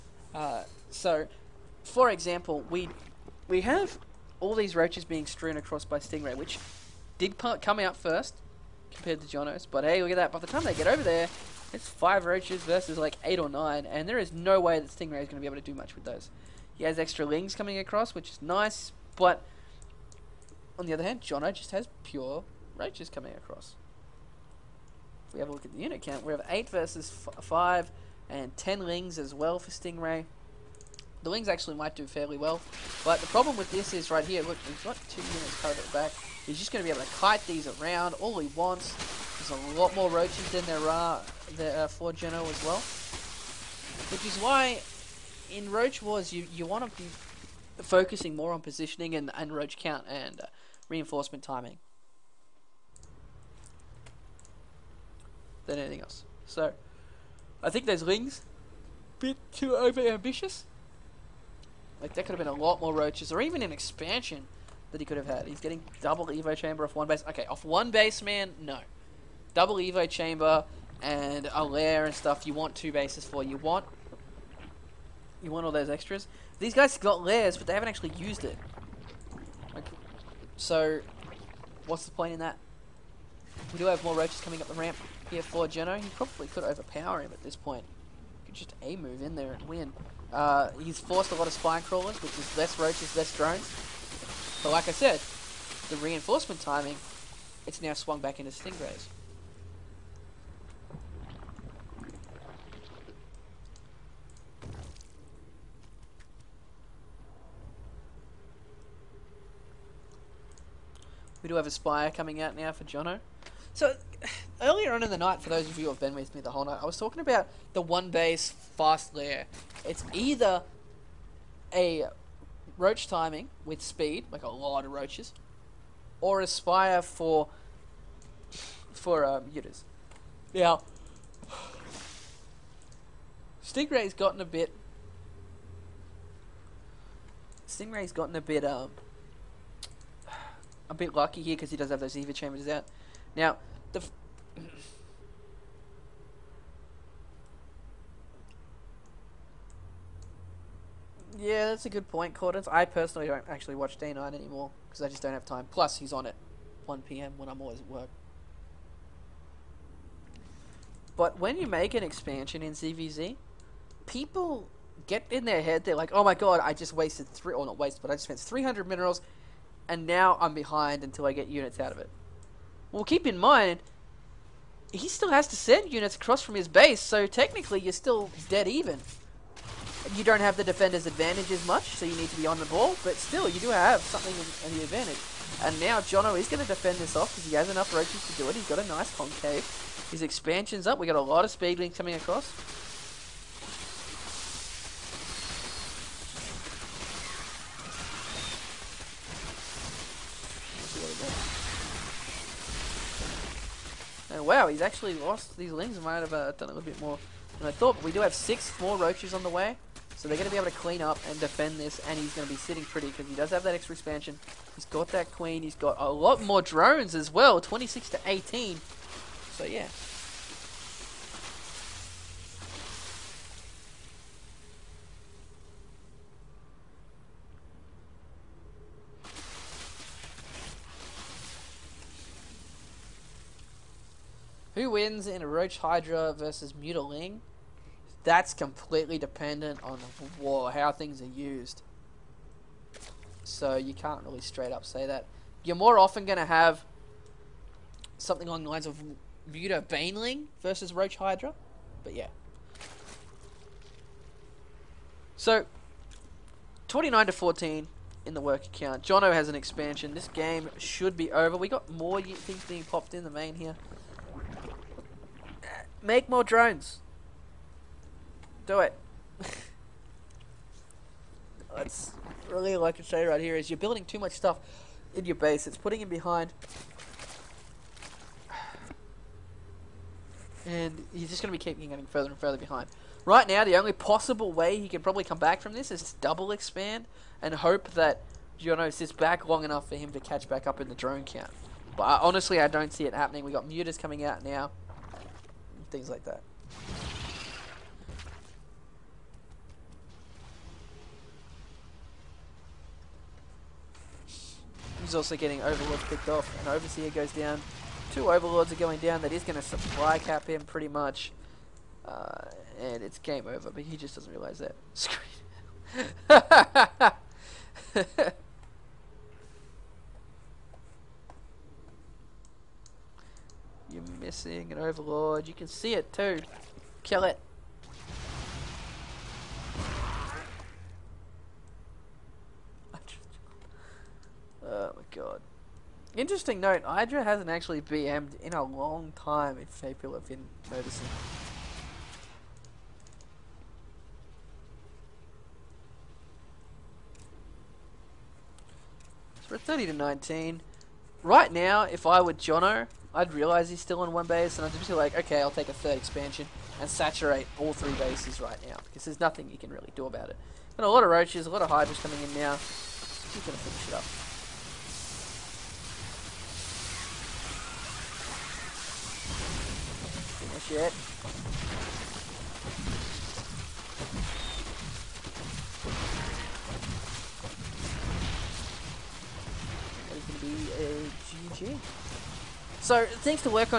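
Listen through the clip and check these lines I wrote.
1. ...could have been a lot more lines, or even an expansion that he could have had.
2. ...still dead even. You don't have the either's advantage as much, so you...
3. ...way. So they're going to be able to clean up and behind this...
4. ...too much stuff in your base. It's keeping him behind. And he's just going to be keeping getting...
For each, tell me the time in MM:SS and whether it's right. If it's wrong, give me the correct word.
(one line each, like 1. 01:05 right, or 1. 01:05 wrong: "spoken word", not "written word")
1. 01:02 wrong: "roaches", not "lines"
2. 02:57 wrong: "defender", not "either"
3. 03:29 wrong: "defend", not "behind"
4. 04:34 wrong: "putting", not "keeping".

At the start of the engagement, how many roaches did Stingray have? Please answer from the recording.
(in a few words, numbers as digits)
5.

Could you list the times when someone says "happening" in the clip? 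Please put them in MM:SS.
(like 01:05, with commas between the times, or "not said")
04:53.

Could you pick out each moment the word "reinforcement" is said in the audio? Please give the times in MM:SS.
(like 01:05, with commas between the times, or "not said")
00:50, 01:35.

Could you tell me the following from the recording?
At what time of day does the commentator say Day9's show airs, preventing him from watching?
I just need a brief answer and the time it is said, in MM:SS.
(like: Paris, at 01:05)
1 p.m., at 02:36.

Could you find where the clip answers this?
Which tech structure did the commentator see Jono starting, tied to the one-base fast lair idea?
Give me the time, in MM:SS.
01:51.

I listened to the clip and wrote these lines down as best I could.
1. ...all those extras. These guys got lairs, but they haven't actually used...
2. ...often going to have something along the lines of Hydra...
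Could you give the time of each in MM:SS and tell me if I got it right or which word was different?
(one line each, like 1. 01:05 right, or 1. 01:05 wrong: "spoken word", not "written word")
1. 01:15 right
2. 04:05 wrong: "Muta", not "Hydra".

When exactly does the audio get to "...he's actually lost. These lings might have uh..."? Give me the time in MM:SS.
03:24.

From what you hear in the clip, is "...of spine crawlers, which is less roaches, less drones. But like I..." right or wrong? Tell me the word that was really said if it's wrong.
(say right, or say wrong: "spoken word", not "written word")
right.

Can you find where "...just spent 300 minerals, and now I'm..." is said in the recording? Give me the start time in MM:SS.
02:48.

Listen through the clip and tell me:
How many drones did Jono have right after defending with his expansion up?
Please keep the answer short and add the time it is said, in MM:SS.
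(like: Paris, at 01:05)
26, at 03:37.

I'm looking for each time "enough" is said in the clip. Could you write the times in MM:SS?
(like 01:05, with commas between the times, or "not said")
03:07, 04:49.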